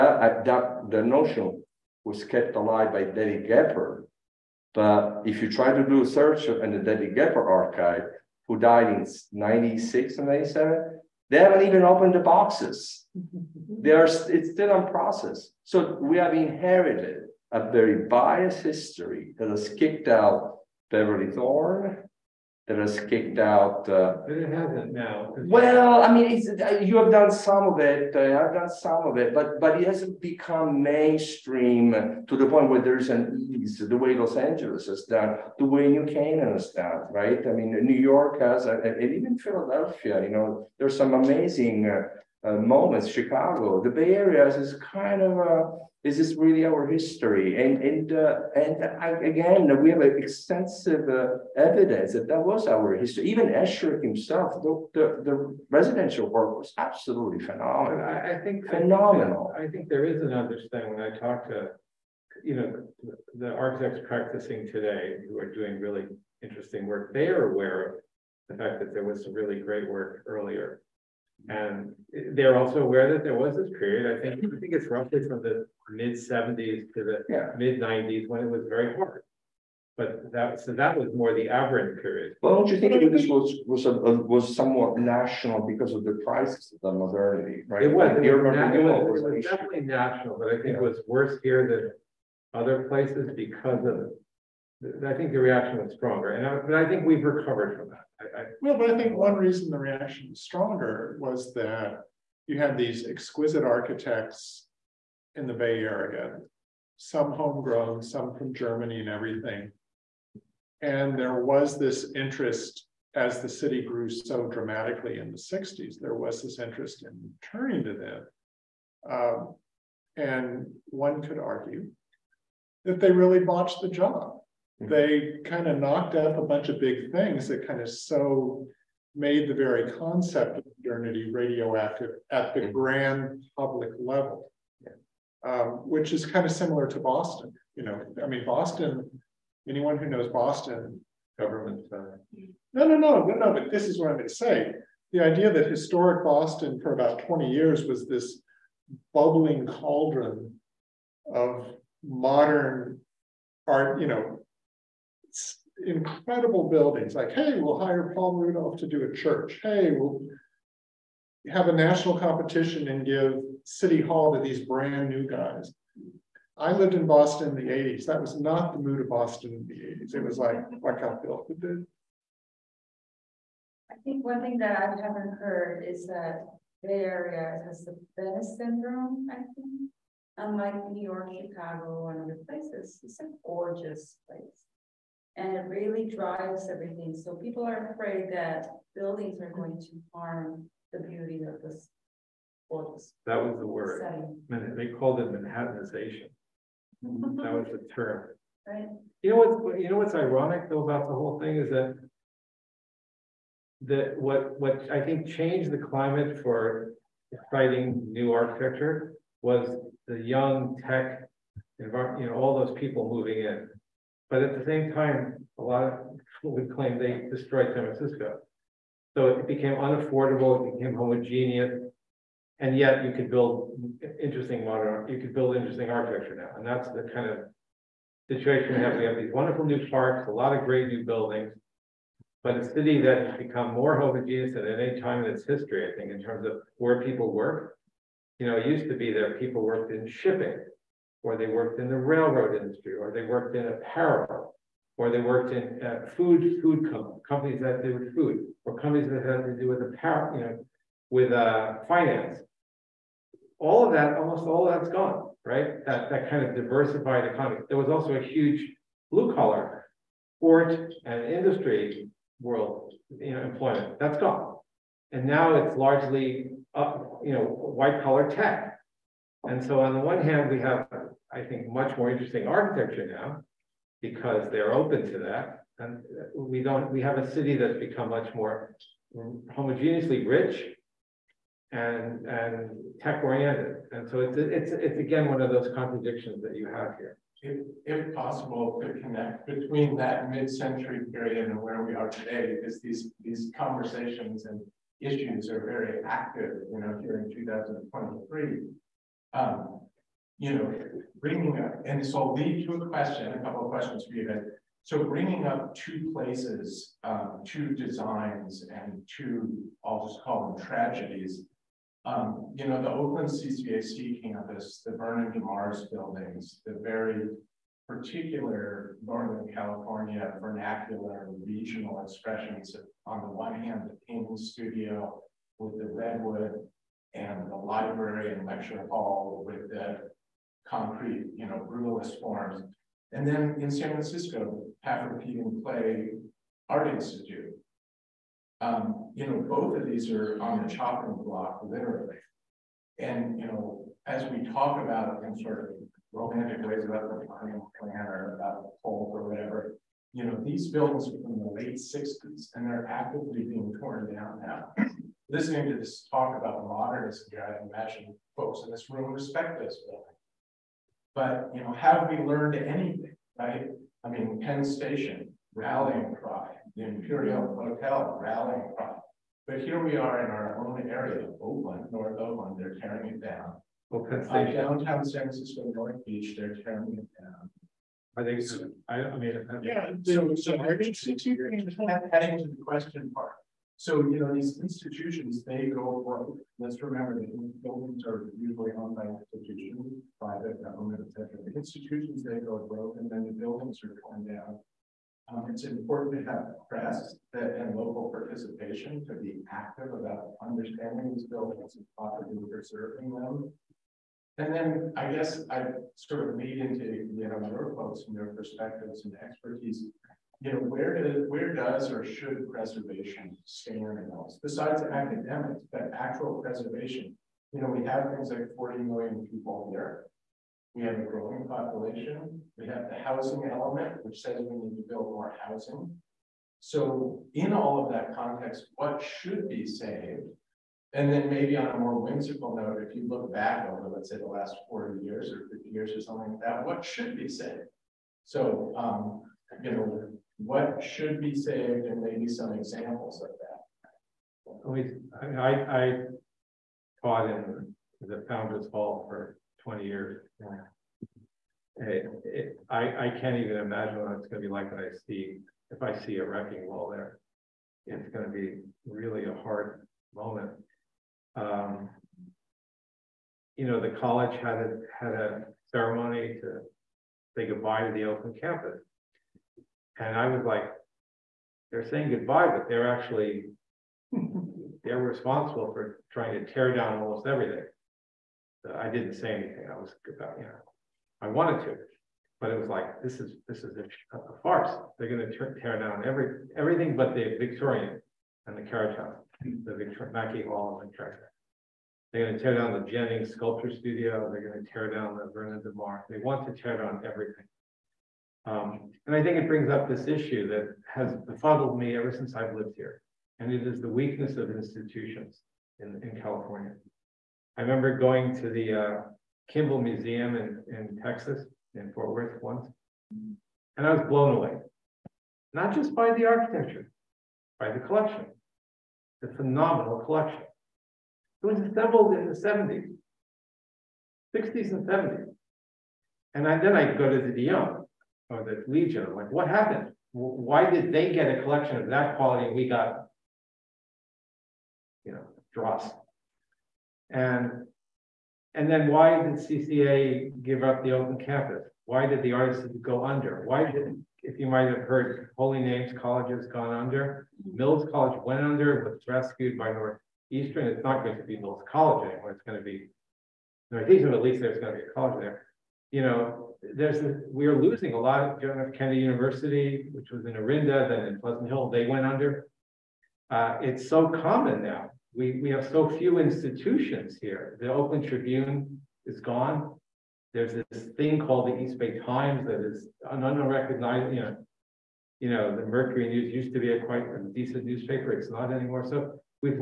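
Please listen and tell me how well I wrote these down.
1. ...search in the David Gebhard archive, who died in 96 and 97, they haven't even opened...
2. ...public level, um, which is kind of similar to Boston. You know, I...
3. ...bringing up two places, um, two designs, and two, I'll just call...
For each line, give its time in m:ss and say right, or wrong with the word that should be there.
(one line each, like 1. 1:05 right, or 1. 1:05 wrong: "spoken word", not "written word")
1. 0:06 right
2. 2:13 right
3. 5:05 right.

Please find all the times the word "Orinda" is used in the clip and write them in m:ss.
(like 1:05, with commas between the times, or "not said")
9:20.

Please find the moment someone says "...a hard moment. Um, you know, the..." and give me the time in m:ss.
7:39.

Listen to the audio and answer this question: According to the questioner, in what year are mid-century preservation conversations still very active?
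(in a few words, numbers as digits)
2023.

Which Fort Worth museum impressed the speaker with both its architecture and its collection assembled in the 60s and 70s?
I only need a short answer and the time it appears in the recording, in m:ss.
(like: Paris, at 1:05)
Kimbell Museum, at 8:29.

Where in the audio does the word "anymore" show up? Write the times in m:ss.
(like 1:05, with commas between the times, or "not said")
9:12, 9:38.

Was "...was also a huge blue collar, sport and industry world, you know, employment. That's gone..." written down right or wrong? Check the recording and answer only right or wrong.
right.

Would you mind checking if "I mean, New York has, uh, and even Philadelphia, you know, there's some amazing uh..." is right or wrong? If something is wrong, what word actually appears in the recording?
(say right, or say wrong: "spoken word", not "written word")
right.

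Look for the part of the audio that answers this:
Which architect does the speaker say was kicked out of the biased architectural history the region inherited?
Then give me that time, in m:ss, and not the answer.
0:20.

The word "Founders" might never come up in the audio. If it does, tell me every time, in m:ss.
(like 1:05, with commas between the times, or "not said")
7:28.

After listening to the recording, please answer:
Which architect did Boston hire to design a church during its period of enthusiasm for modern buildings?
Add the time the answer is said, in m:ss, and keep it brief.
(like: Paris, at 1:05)
Paul Rudolph, at 2:38.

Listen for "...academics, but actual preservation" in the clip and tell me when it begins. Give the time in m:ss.
6:54.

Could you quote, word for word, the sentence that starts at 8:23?
And it is the weakness of institutions in, in California.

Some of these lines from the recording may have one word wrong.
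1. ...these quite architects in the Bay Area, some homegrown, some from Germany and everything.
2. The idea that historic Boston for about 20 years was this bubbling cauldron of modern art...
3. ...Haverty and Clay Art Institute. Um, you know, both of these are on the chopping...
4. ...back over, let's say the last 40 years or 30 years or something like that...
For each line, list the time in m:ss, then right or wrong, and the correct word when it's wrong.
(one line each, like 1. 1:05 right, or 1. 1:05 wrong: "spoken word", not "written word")
1. 1:42 wrong: "exquisite", not "quite"
2. 2:25 right
3. 5:34 right
4. 7:13 wrong: "50", not "30".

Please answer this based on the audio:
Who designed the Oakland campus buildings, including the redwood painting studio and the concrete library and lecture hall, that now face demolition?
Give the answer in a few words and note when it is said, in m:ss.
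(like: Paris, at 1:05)
Vernon DeMars, at 5:14.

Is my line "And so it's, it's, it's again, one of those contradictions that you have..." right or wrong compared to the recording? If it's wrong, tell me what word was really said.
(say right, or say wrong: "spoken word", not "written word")
right.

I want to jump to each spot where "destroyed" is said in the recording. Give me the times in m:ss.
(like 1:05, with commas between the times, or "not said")
3:37.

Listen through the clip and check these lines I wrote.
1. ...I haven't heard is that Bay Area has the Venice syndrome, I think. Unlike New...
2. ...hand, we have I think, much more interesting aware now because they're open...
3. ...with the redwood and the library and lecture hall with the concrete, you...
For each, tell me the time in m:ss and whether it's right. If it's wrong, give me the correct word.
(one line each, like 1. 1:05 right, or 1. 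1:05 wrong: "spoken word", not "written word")
1. 2:54 right
2. 4:30 wrong: "architecture", not "aware"
3. 5:25 right.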